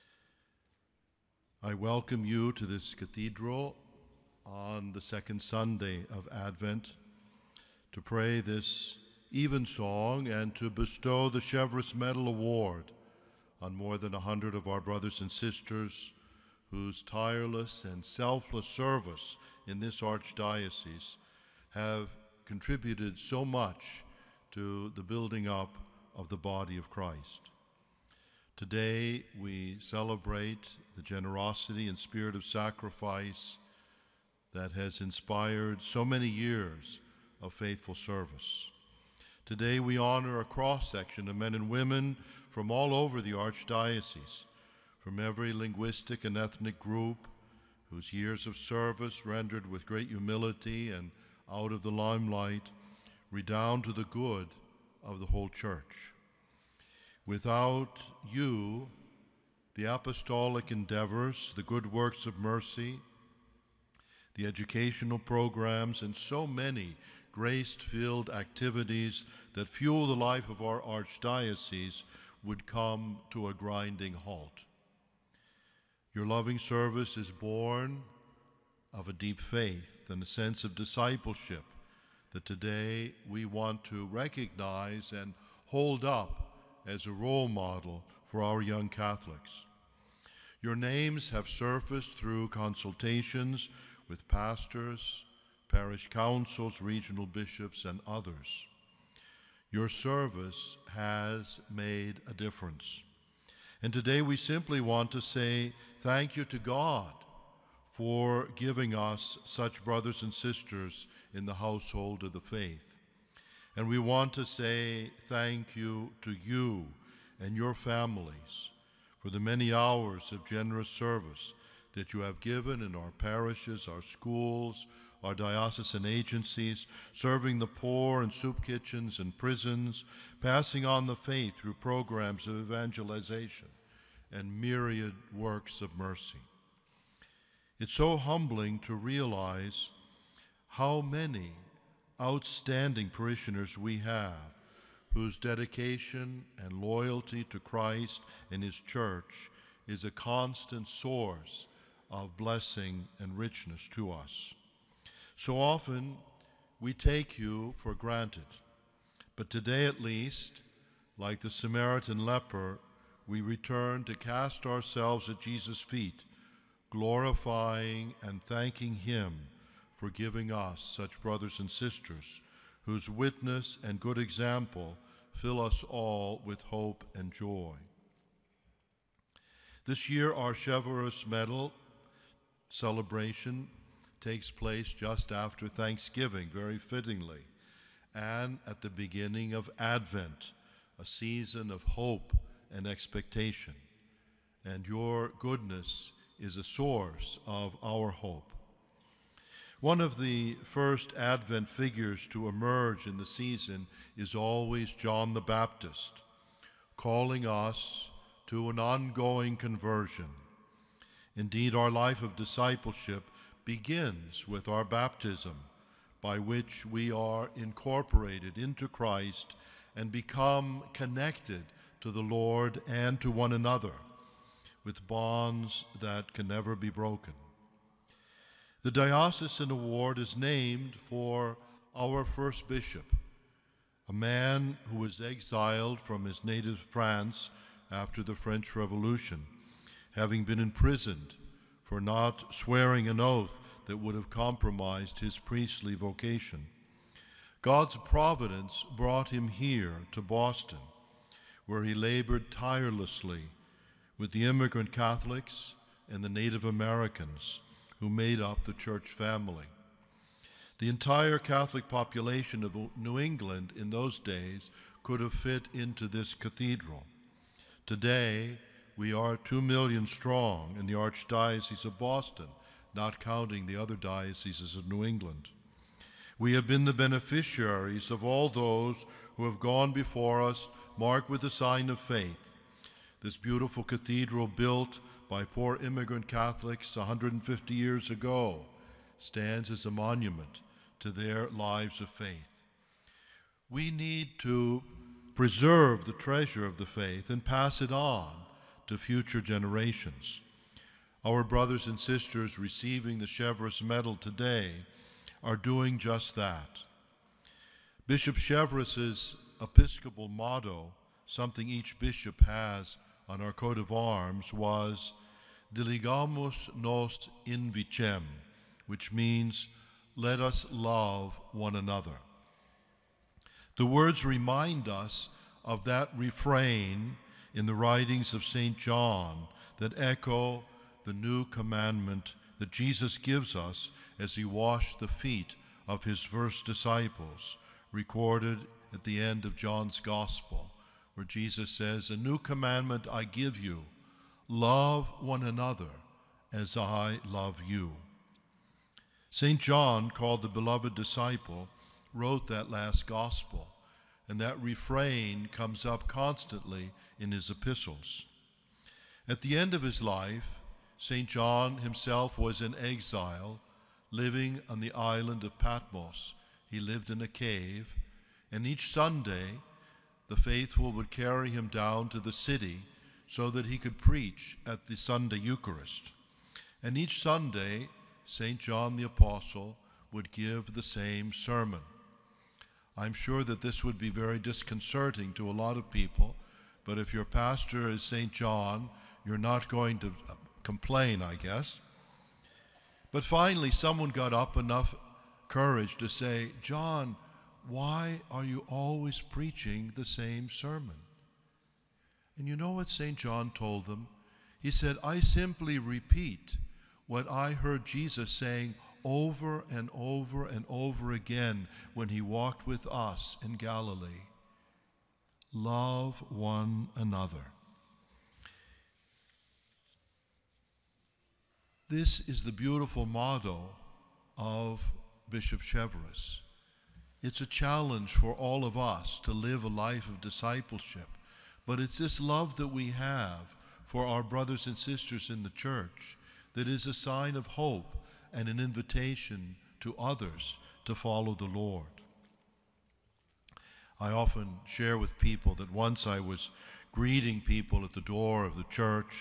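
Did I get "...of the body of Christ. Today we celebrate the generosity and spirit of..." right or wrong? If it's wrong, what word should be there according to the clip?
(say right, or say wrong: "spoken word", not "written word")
right.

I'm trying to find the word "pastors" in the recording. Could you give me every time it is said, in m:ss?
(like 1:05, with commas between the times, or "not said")
1:34, 6:27.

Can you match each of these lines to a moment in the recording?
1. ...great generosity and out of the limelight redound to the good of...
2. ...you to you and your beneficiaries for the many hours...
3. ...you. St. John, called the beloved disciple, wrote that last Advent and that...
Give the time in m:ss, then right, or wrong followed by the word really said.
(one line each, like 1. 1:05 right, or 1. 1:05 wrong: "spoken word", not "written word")
1. 0:49 wrong: "humility", not "generosity"
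2. 1:55 wrong: "families", not "beneficiaries"
3. 5:47 wrong: "Gospel", not "Advent".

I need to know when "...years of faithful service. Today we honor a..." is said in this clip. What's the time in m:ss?
0:36.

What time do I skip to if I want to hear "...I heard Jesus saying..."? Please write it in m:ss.
6:47.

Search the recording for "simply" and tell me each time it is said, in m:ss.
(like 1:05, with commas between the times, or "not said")
1:44, 6:45.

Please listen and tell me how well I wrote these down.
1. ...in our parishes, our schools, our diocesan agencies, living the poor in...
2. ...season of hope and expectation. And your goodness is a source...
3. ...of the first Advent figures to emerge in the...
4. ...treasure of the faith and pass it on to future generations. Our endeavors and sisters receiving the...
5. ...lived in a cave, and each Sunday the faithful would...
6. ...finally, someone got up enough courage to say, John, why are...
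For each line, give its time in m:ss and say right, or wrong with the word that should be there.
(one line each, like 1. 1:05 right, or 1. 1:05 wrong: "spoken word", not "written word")
1. 2:02 wrong: "serving", not "living"
2. 3:11 right
3. 3:20 right
4. 4:56 wrong: "brothers", not "endeavors"
5. 6:06 right
6. 6:33 right.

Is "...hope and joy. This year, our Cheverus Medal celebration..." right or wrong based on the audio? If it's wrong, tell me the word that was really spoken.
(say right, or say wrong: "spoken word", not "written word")
right.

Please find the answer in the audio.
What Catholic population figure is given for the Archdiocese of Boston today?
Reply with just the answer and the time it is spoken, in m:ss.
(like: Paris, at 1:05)
2 million, at 4:29.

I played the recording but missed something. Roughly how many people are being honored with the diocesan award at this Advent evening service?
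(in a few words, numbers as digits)
more than 100.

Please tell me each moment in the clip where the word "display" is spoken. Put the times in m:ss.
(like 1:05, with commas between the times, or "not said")
not said.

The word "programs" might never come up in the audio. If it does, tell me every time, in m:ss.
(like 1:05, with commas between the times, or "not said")
1:05, 2:11.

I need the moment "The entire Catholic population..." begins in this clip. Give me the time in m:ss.
4:20.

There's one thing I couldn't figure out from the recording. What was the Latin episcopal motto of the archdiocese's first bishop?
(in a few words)
Diligamus nos in vicem.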